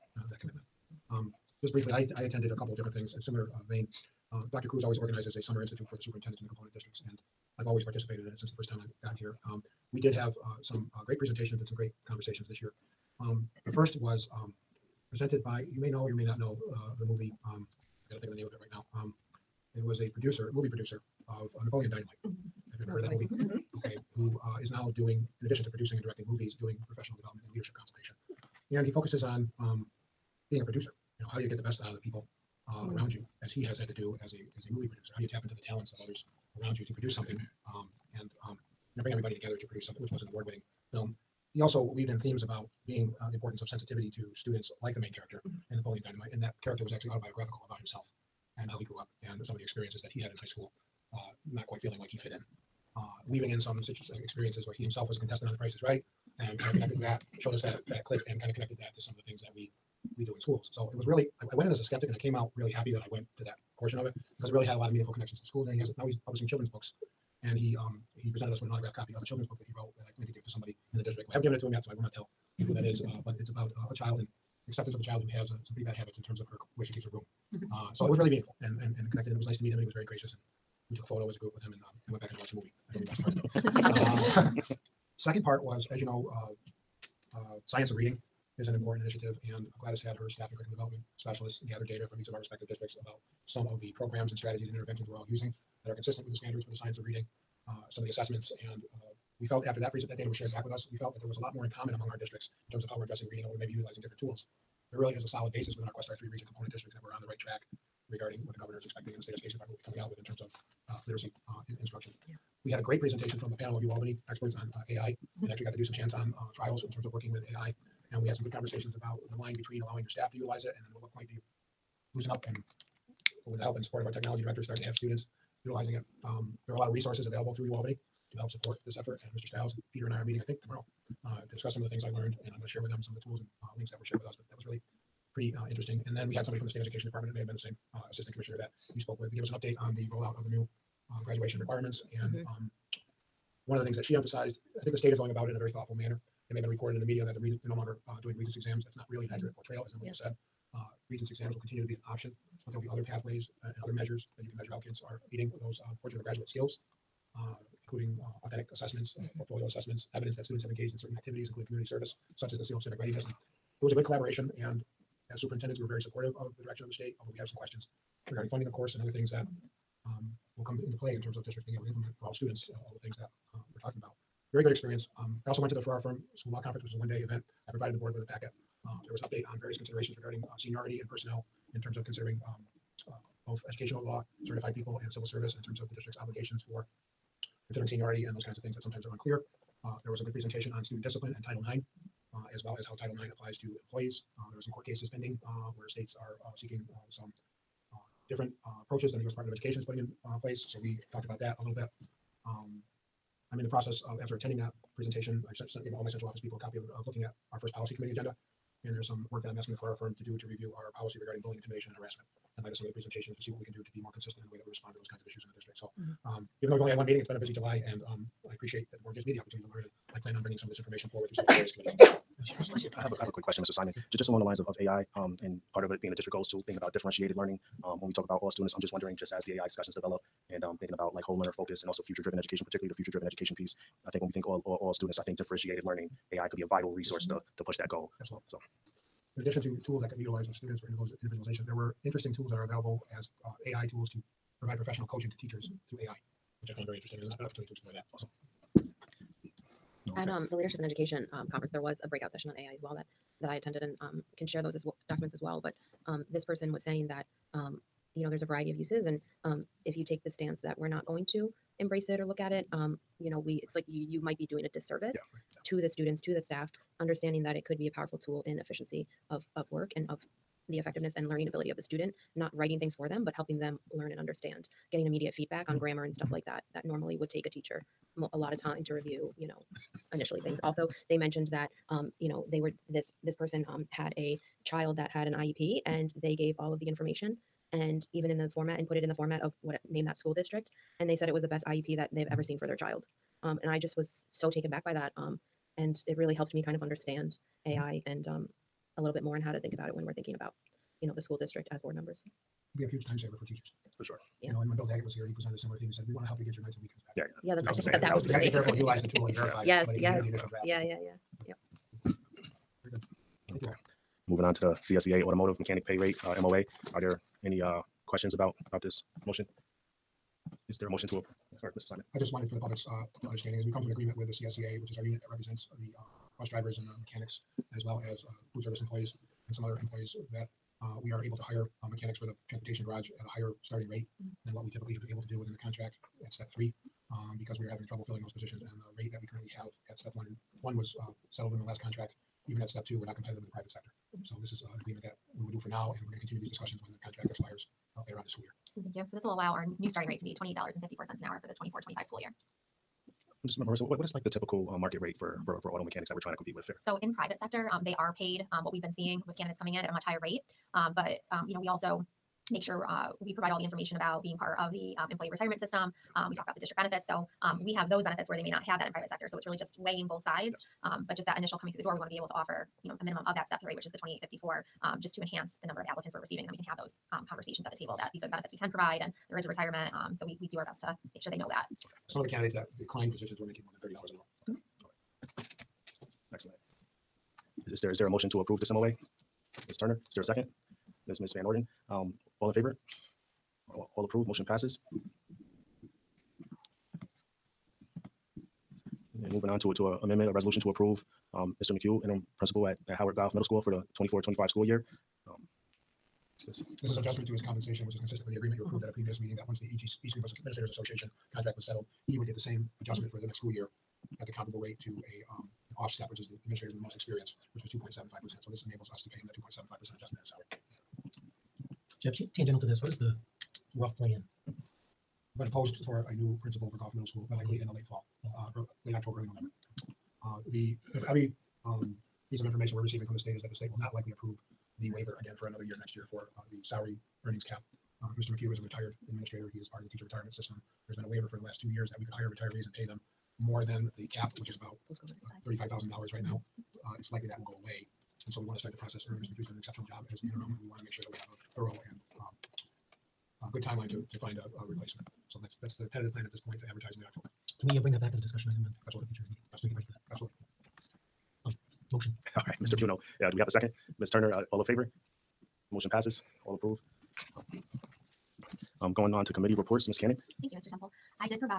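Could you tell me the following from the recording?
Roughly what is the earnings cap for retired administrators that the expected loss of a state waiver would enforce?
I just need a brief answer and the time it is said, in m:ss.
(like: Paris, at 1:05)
$35,000, at 7:25.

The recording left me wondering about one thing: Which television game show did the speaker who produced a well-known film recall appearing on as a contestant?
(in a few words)
The Price is Right.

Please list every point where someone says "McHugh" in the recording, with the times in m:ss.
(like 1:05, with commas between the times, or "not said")
6:41, 7:18, 7:29.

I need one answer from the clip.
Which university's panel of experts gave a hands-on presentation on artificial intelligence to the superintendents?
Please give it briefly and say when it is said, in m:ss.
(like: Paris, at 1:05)
UAlbany, at 1:53.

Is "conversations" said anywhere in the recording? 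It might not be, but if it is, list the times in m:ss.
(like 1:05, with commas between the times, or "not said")
0:12, 1:58, 6:17.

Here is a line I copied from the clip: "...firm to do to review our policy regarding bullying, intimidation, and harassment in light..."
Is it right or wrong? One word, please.
right.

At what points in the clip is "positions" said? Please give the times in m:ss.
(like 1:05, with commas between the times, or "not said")
5:38, 6:23.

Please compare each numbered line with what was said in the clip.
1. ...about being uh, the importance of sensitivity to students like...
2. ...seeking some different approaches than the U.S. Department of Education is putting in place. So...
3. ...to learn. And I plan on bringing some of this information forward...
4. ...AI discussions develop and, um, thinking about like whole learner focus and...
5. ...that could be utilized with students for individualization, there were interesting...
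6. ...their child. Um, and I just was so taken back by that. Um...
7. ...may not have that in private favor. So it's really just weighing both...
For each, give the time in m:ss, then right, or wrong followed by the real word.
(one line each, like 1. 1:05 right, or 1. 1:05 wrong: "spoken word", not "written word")
1. 0:42 right
2. 3:16 right
3. 3:39 right
4. 3:49 right
5. 4:00 right
6. 4:52 right
7. 6:08 wrong: "sector", not "favor".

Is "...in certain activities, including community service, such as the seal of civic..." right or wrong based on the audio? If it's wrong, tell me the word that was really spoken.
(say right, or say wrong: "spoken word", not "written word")
right.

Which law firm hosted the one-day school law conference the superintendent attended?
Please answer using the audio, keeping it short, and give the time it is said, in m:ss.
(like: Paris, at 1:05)
Ferrara Firm, at 2:55.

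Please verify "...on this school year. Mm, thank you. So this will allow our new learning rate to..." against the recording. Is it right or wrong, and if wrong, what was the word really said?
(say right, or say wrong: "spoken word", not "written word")
wrong: "starting", not "learning".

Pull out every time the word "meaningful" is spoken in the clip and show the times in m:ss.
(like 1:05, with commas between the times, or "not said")
1:04, 1:18.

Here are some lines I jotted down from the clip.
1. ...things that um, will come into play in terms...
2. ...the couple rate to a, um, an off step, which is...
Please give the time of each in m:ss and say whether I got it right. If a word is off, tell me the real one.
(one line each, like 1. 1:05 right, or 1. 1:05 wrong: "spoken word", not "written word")
1. 2:49 right
2. 6:54 wrong: "comparable", not "couple".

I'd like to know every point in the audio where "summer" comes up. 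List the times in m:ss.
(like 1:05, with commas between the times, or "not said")
0:05.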